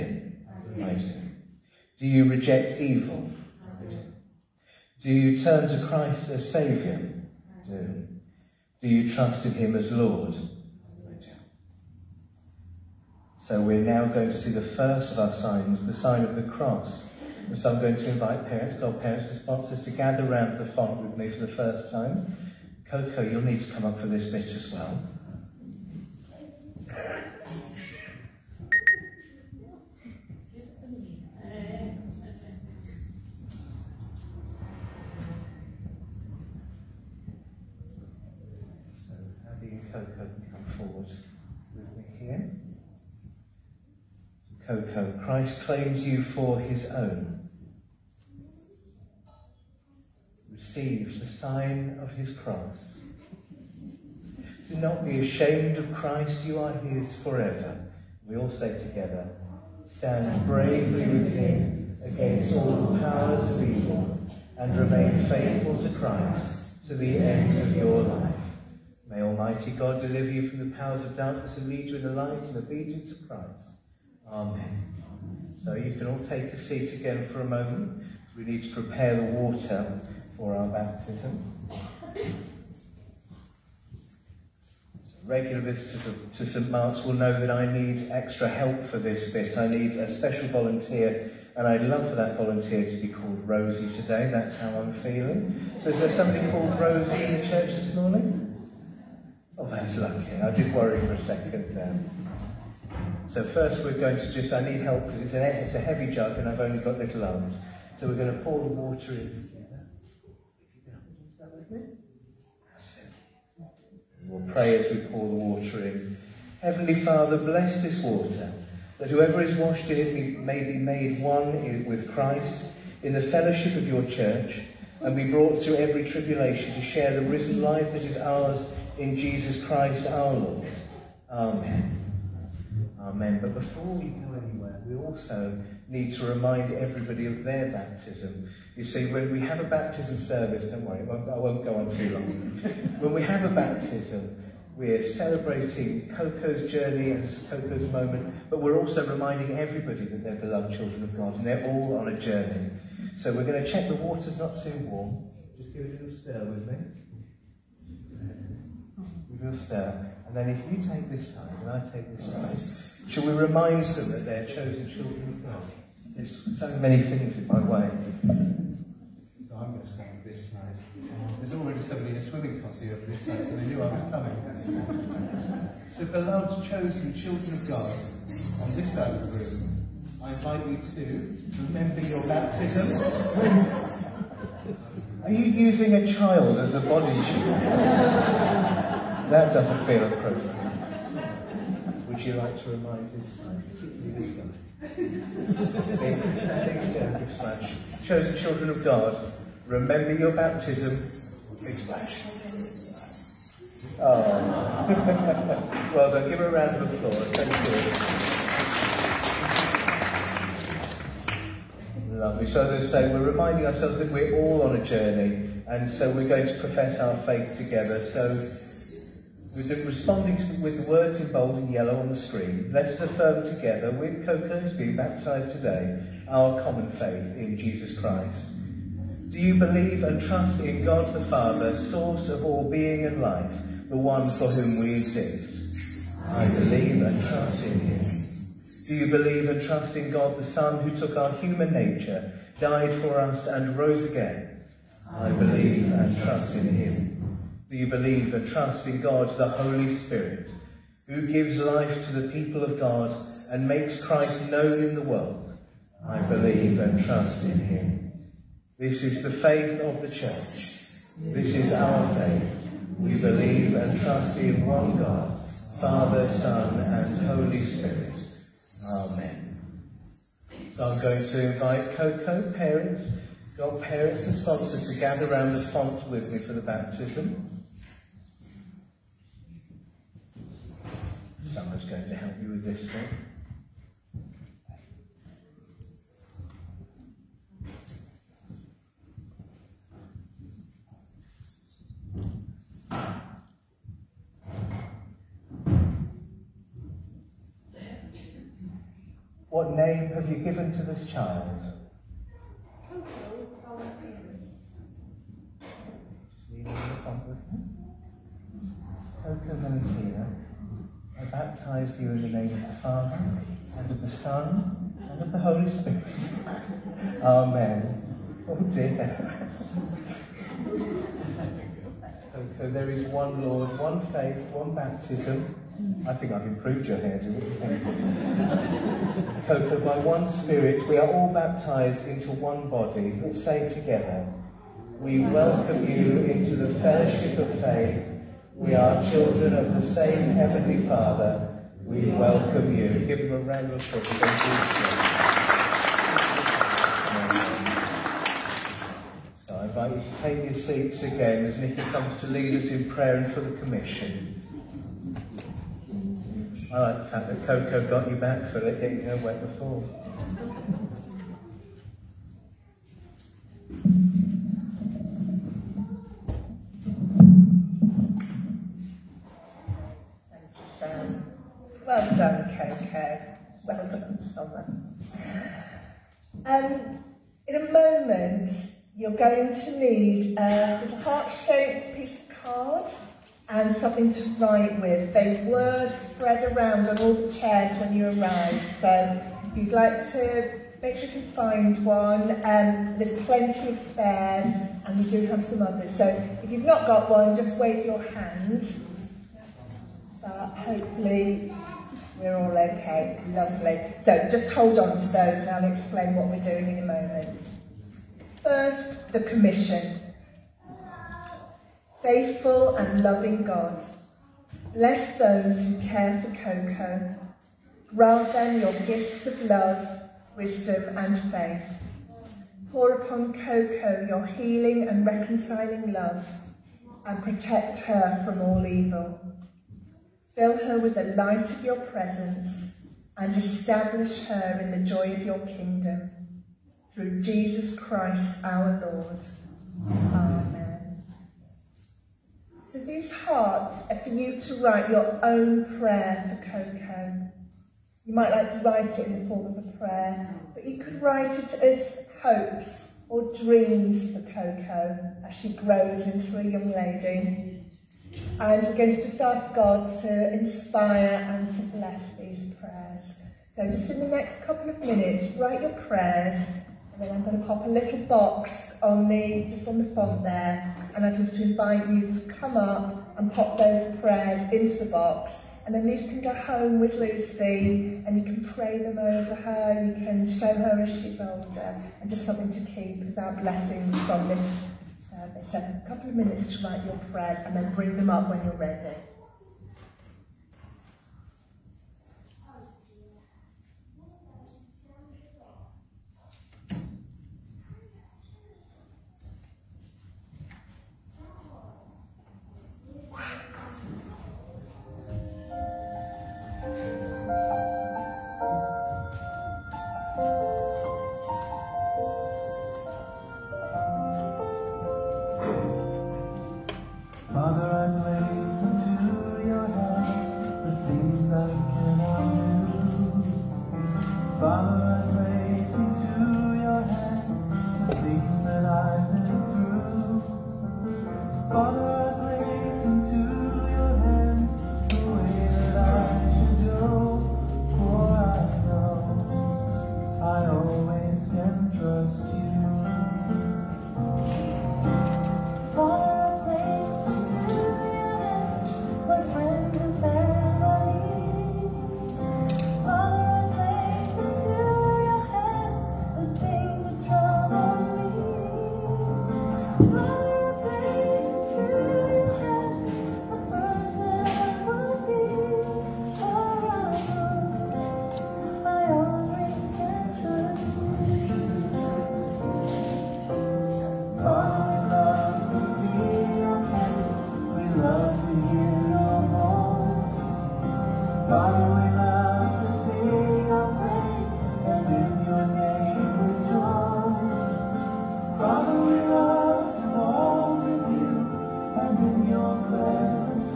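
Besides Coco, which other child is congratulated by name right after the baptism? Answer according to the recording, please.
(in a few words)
Summer.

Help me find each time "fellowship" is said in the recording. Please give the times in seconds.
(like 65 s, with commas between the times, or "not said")
123 s, 336 s.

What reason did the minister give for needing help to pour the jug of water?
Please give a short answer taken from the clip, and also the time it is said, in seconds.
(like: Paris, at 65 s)
Only got little arms, at 106 s.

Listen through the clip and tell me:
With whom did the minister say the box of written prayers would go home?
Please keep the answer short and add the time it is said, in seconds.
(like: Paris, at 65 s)
Lucy, at 476 s.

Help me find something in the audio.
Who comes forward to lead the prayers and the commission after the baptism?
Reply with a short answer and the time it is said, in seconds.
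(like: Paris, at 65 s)
Nicky, at 351 s.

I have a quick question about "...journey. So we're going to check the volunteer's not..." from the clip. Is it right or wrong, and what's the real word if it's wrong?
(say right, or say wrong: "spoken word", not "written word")
wrong: "water", not "volunteer".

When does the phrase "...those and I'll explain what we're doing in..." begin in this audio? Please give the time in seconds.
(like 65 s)
405 s.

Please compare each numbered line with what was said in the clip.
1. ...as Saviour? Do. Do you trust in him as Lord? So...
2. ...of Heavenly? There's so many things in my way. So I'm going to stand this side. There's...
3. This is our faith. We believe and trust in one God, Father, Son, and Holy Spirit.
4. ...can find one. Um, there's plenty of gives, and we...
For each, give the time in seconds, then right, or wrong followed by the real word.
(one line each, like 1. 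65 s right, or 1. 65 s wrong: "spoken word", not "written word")
1. 6 s right
2. 165 s wrong: "God", not "Heavenly"
3. 261 s right
4. 391 s wrong: "spares", not "gives".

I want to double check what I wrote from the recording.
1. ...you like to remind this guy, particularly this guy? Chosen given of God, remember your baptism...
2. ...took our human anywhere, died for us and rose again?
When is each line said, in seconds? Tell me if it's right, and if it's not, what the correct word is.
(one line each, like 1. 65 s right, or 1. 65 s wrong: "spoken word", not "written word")
1. 192 s wrong: "children", not "given"
2. 240 s wrong: "nature", not "anywhere".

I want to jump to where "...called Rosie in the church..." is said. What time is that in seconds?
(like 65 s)
96 s.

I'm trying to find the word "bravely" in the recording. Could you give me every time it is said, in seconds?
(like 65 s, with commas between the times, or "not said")
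60 s.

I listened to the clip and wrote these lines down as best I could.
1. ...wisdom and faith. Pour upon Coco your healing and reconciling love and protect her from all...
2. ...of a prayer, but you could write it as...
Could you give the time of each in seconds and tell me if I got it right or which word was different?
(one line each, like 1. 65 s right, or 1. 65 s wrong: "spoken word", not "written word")
1. 420 s right
2. 449 s right.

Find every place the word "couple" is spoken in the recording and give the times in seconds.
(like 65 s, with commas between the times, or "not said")
464 s, 485 s.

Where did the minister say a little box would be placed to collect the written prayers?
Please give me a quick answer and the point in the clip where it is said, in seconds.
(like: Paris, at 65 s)
On the font, at 469 s.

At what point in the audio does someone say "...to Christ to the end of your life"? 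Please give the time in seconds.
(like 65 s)
65 s.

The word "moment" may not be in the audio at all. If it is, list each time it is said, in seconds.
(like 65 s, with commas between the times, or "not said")
77 s, 147 s, 377 s, 406 s.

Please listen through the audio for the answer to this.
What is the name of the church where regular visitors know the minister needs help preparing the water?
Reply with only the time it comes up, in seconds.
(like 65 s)
86 s.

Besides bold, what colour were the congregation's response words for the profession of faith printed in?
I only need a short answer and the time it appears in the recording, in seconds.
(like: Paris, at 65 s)
Yellow, at 221 s.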